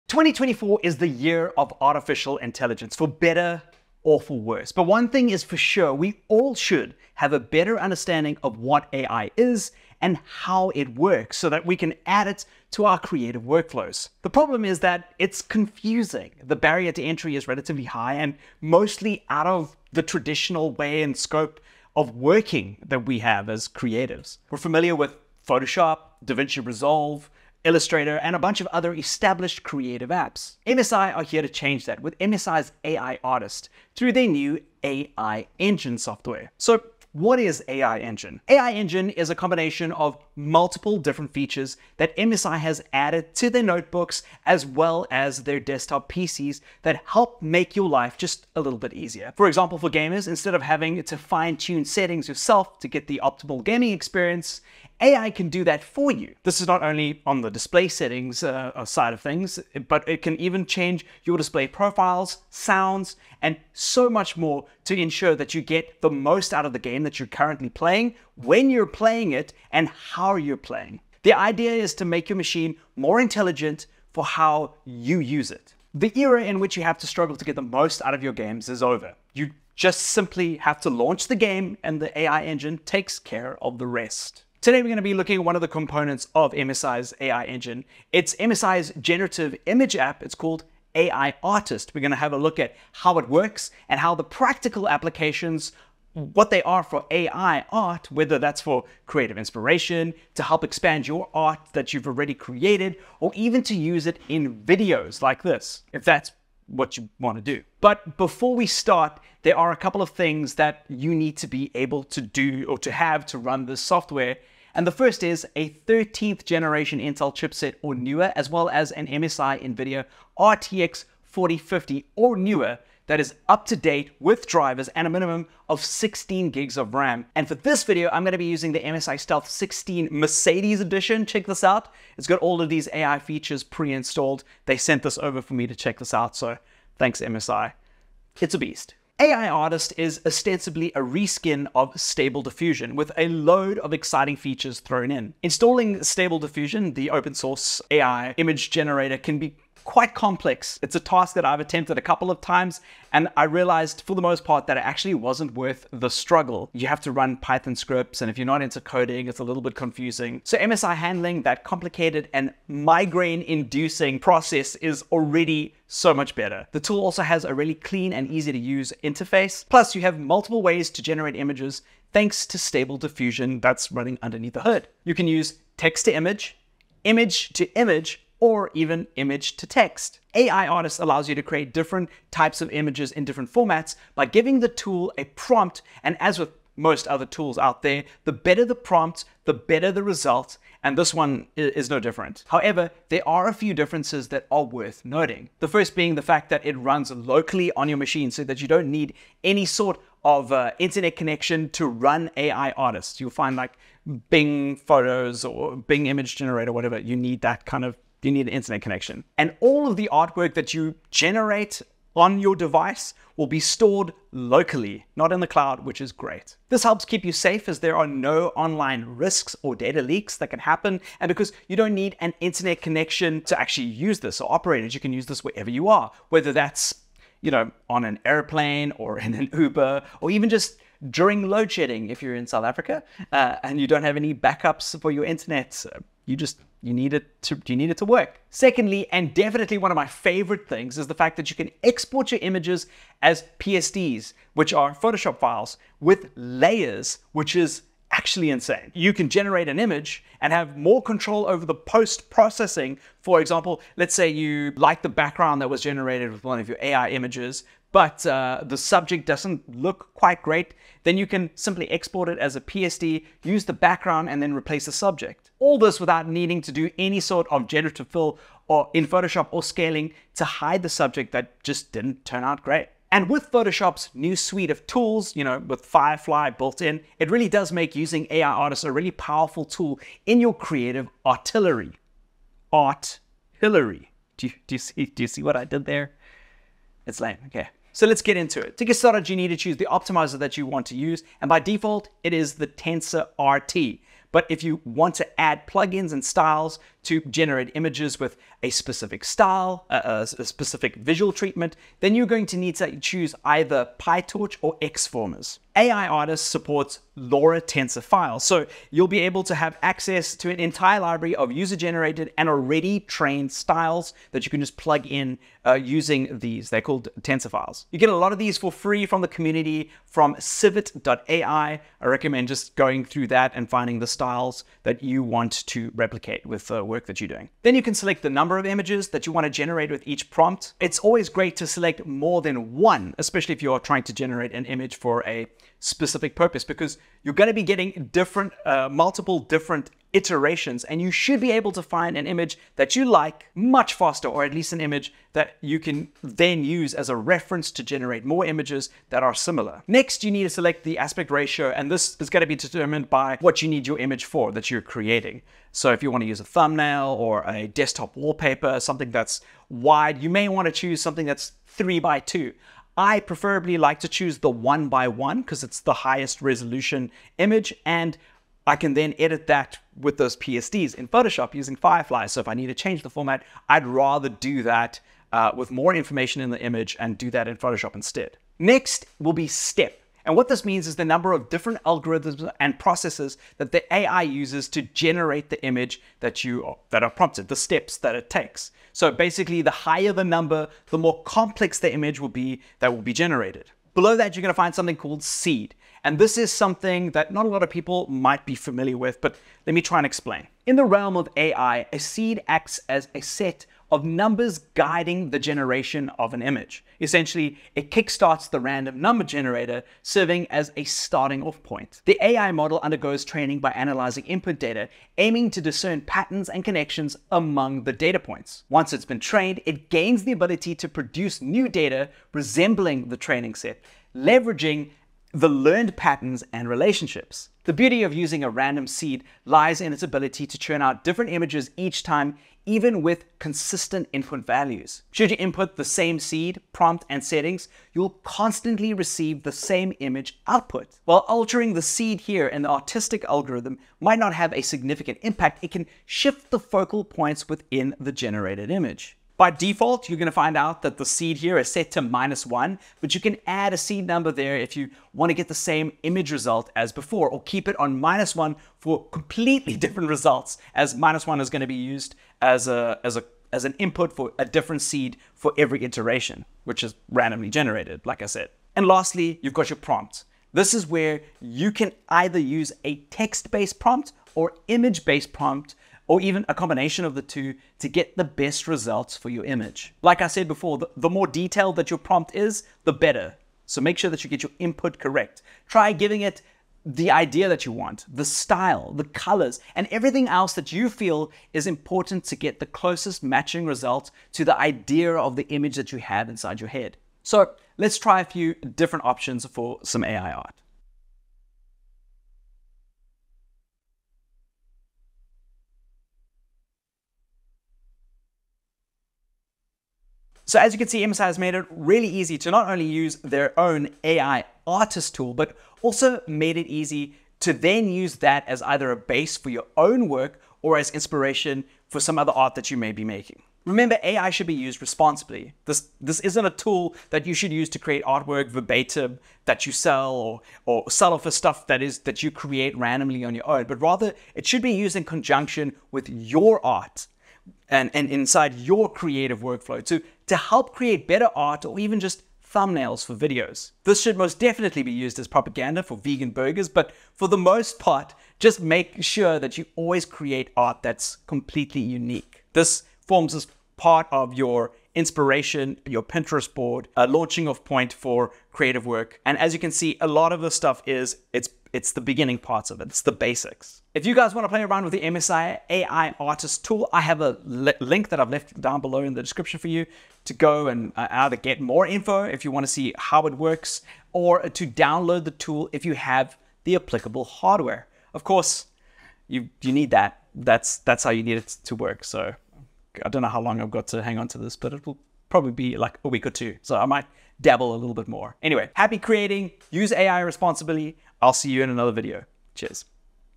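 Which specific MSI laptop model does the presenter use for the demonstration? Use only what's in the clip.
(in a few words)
MSI Stealth 16 Mercedes edition.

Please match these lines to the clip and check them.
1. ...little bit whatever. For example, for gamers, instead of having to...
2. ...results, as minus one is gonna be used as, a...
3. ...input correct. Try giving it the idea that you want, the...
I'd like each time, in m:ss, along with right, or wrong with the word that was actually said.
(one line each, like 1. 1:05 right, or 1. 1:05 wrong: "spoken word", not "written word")
1. 0:48 wrong: "easier", not "whatever"
2. 7:40 right
3. 8:04 right.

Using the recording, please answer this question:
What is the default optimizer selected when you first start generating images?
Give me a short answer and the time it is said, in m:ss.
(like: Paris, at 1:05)
TensorRT, at 4:52.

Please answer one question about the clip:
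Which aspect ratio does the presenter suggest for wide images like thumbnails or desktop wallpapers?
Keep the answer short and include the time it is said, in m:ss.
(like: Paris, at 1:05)
3 by 2, at 6:01.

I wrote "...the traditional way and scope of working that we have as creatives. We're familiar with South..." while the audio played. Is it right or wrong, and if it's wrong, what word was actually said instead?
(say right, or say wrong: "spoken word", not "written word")
wrong: "Photoshop", not "South".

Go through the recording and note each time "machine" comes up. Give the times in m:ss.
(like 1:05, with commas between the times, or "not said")
1:12, 3:17.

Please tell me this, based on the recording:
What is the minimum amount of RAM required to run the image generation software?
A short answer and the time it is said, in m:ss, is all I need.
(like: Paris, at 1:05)
16 gigs, at 2:05.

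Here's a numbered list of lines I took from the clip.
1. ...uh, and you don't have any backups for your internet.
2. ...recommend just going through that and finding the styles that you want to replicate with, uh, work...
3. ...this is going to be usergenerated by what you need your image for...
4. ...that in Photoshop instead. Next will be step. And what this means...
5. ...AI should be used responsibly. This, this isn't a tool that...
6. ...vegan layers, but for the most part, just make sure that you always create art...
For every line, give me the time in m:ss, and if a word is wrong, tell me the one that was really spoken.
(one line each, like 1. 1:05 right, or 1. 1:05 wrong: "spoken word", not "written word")
1. 3:53 right
2. 5:22 right
3. 5:51 wrong: "determined", not "usergenerated"
4. 6:17 right
5. 8:44 right
6. 9:05 wrong: "burgers", not "layers".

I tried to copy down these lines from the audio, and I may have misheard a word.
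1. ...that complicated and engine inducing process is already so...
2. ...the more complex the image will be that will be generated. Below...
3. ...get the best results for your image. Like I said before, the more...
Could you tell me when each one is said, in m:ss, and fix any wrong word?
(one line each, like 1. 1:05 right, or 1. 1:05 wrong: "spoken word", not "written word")
1. 2:41 wrong: "migraine", not "engine"
2. 6:30 right
3. 7:57 right.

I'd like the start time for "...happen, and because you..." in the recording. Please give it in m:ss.
3:40.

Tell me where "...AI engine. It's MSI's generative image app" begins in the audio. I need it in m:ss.
1:27.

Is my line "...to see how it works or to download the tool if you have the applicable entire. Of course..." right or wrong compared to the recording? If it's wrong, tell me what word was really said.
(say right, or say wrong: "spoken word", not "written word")
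wrong: "hardware", not "entire".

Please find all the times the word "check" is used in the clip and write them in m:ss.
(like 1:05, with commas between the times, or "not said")
2:11, 2:15.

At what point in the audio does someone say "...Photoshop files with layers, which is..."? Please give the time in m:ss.
4:04.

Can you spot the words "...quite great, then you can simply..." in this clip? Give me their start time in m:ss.
4:20.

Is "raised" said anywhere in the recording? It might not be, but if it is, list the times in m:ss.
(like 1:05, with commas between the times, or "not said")
not said.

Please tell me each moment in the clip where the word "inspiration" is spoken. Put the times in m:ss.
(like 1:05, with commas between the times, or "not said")
1:39, 8:40, 9:14.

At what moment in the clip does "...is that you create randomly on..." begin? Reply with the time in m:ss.
8:51.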